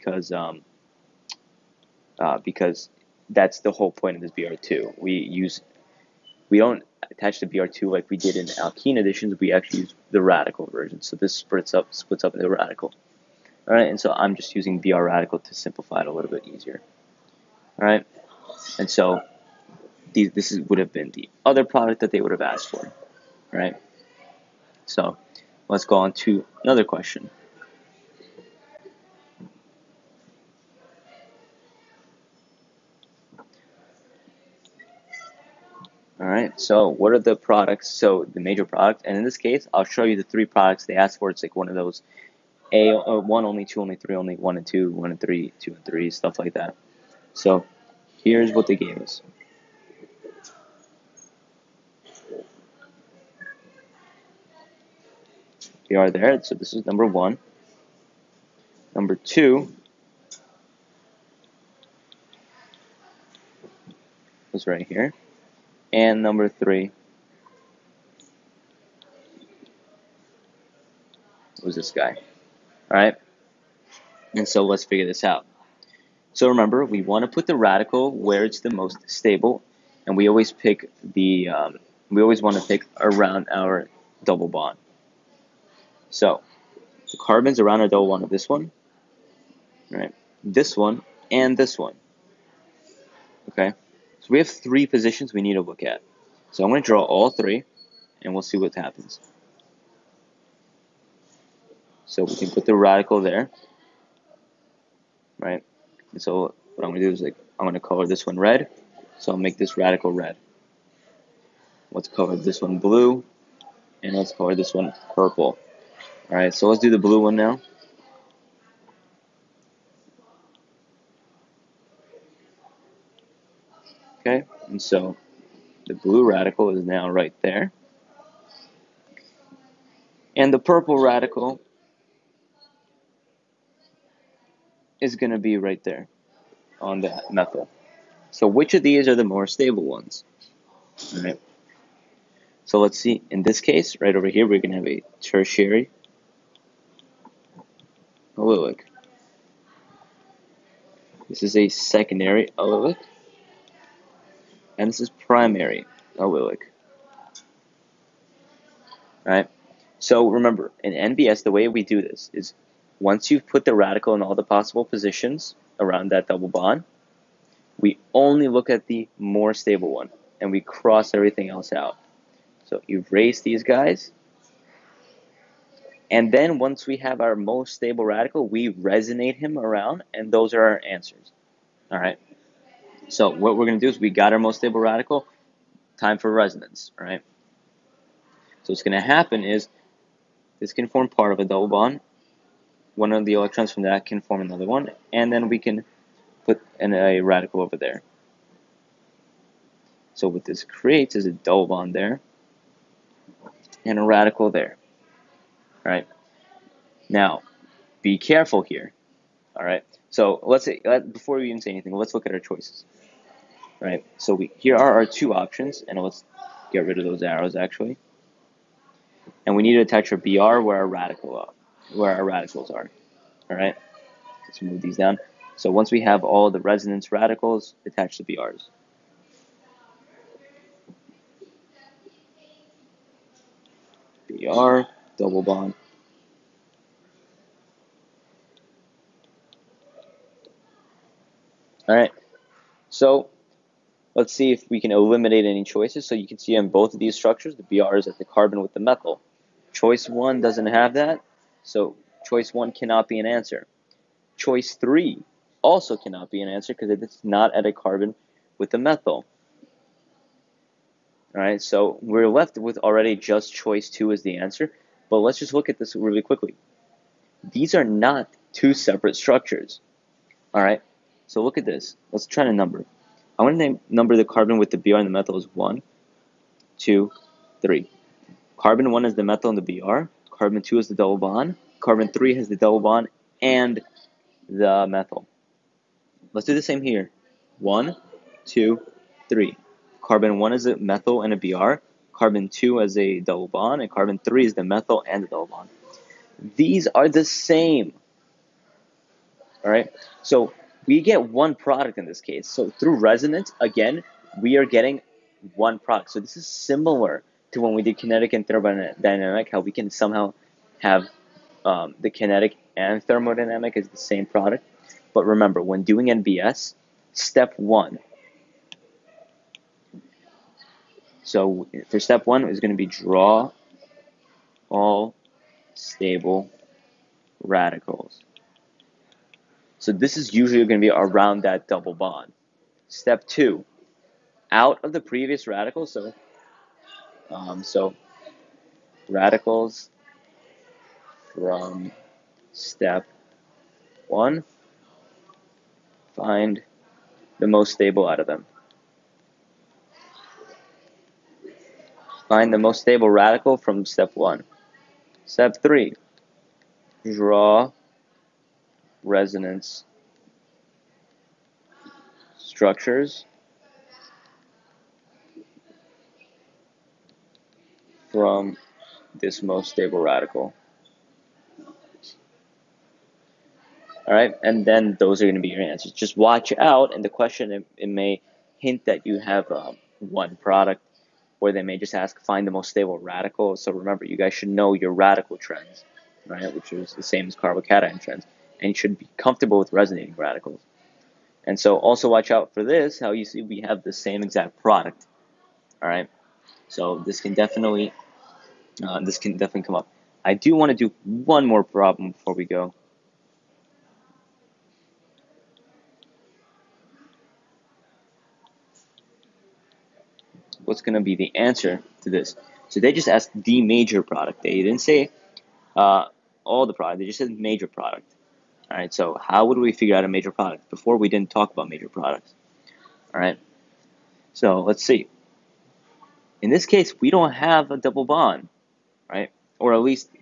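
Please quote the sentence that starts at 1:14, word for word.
And so let's figure this out.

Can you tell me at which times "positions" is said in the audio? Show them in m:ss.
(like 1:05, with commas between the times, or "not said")
1:34, 2:44.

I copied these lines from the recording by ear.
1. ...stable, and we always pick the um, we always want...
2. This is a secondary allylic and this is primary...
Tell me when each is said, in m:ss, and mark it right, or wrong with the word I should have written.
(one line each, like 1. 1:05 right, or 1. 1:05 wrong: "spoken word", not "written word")
1. 1:19 right
2. 2:31 right.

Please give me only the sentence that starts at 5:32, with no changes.
Step two, out of the previous radical.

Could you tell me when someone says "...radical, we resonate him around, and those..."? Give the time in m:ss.
2:58.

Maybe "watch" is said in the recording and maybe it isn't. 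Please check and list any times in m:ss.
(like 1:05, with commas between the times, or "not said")
6:16, 6:32.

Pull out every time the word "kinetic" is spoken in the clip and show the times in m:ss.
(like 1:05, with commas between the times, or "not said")
5:07, 5:12.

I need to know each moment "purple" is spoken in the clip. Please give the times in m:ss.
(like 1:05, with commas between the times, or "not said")
1:55, 2:10.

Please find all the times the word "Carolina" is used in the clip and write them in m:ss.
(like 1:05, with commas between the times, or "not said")
not said.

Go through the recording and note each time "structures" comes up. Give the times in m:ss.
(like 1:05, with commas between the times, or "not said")
4:07, 4:29, 6:02.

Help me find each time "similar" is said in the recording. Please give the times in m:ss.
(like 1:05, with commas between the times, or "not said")
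5:06.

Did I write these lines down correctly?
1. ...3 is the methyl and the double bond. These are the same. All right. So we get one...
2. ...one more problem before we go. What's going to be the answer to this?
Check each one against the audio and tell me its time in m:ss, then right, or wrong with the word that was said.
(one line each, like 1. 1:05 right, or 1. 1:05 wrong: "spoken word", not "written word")
1. 4:54 right
2. 6:41 right.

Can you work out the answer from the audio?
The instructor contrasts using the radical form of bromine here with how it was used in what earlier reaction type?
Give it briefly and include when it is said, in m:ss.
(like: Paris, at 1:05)
Alkene additions, at 0:08.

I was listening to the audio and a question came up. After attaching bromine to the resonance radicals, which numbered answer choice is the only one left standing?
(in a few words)
Choice 2.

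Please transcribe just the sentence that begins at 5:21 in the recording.
So for step one is going to be draw all stable radicals.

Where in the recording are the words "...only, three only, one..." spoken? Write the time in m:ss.
0:43.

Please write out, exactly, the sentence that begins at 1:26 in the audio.
So the carbons around our double bond of this one, right?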